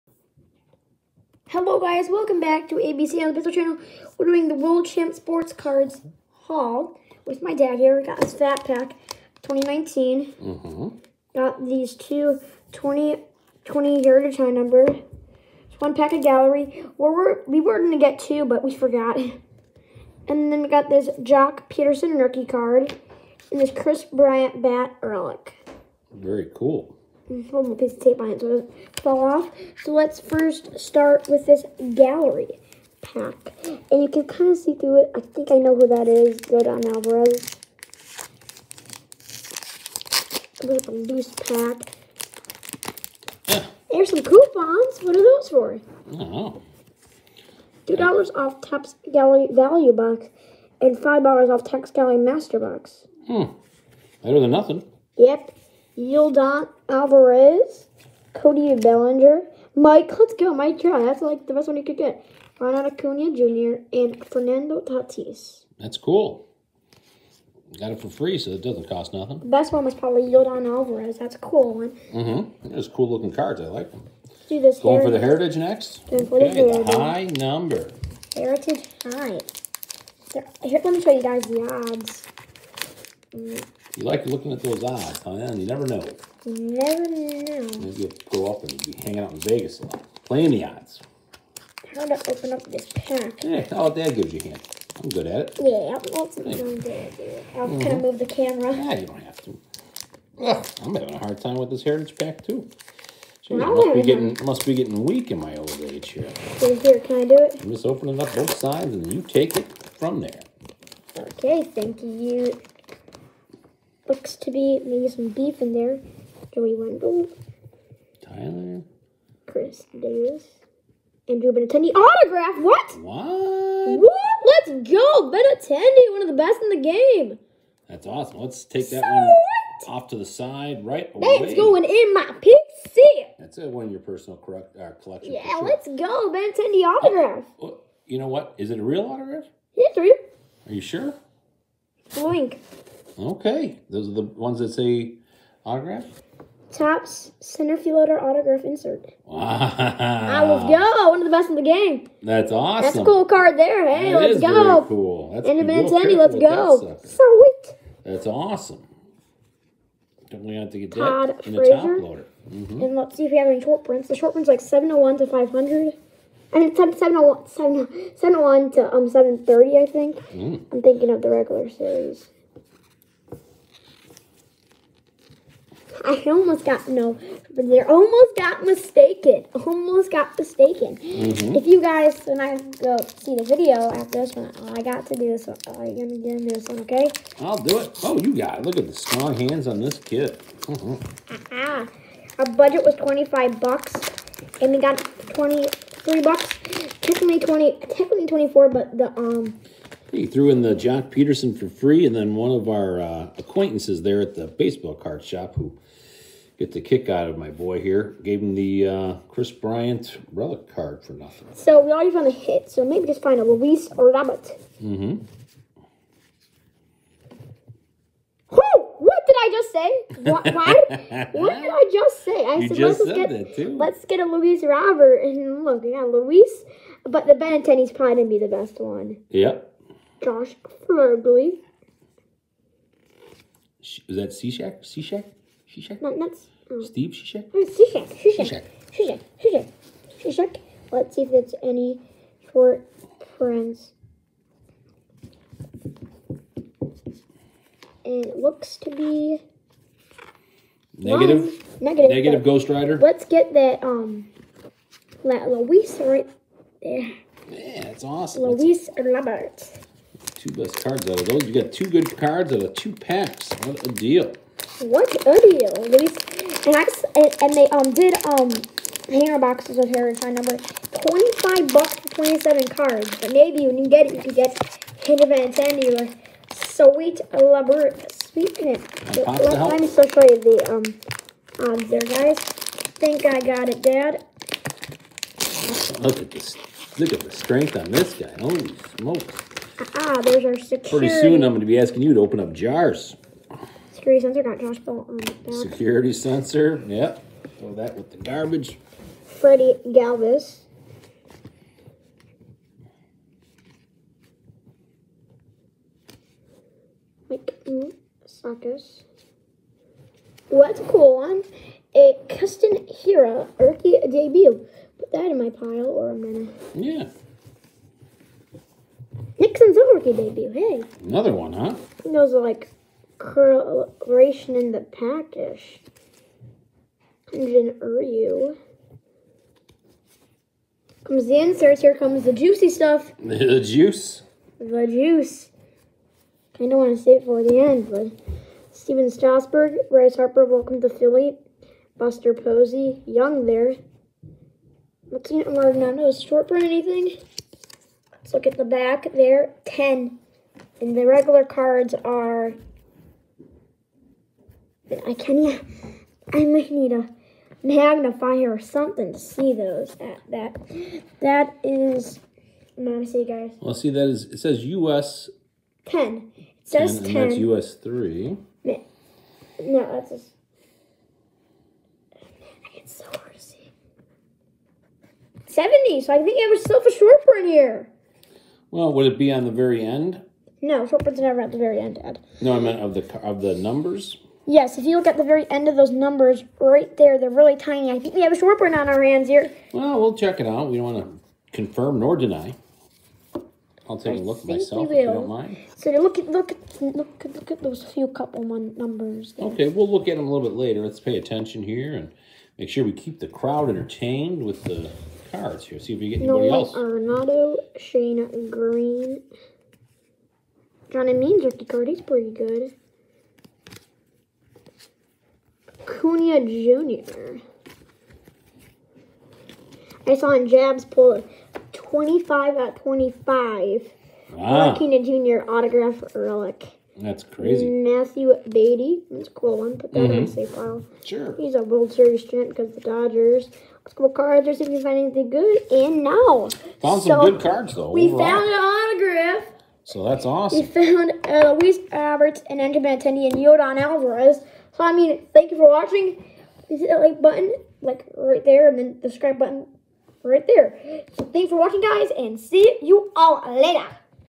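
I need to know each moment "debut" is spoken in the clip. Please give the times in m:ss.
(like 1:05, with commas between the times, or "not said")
5:14, 5:20.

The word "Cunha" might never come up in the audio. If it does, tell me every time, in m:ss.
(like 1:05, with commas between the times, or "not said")
6:55, 7:04.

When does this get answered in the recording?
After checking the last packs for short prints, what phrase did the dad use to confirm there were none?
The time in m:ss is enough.
4:12.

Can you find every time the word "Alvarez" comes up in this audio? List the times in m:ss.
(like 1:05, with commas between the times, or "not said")
0:36, 0:56, 1:10, 7:23.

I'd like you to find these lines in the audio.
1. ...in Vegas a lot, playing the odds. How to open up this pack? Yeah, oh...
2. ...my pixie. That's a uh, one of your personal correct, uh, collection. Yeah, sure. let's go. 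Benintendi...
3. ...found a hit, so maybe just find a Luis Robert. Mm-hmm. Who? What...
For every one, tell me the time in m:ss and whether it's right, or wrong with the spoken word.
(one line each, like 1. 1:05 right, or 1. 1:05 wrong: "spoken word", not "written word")
1. 1:29 right
2. 2:12 right
3. 3:32 right.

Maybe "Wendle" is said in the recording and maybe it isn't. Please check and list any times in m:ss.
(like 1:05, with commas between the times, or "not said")
1:56.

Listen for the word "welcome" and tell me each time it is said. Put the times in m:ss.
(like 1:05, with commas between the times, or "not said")
0:02, 5:40.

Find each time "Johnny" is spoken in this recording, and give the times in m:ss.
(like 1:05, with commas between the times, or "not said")
6:50.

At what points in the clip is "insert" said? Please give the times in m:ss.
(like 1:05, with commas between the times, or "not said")
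2:28, 5:31.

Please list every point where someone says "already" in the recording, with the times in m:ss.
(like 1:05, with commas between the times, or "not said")
3:31, 5:45.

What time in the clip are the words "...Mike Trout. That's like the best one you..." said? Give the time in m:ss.
1:00.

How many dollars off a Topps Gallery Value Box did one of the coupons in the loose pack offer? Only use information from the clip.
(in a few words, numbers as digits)
2.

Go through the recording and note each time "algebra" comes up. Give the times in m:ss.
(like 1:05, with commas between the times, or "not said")
not said.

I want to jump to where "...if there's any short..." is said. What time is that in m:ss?
4:01.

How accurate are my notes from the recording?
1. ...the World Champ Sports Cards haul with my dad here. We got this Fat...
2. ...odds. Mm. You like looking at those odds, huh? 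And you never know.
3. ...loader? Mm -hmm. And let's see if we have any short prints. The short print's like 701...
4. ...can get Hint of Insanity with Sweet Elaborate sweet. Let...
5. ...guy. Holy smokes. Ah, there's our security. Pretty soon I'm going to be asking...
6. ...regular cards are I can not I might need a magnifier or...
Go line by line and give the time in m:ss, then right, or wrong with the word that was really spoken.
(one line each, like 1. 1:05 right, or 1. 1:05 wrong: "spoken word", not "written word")
1. 0:04 right
2. 1:21 right
3. 2:42 right
4. 4:34 right
5. 4:48 right
6. 5:51 right.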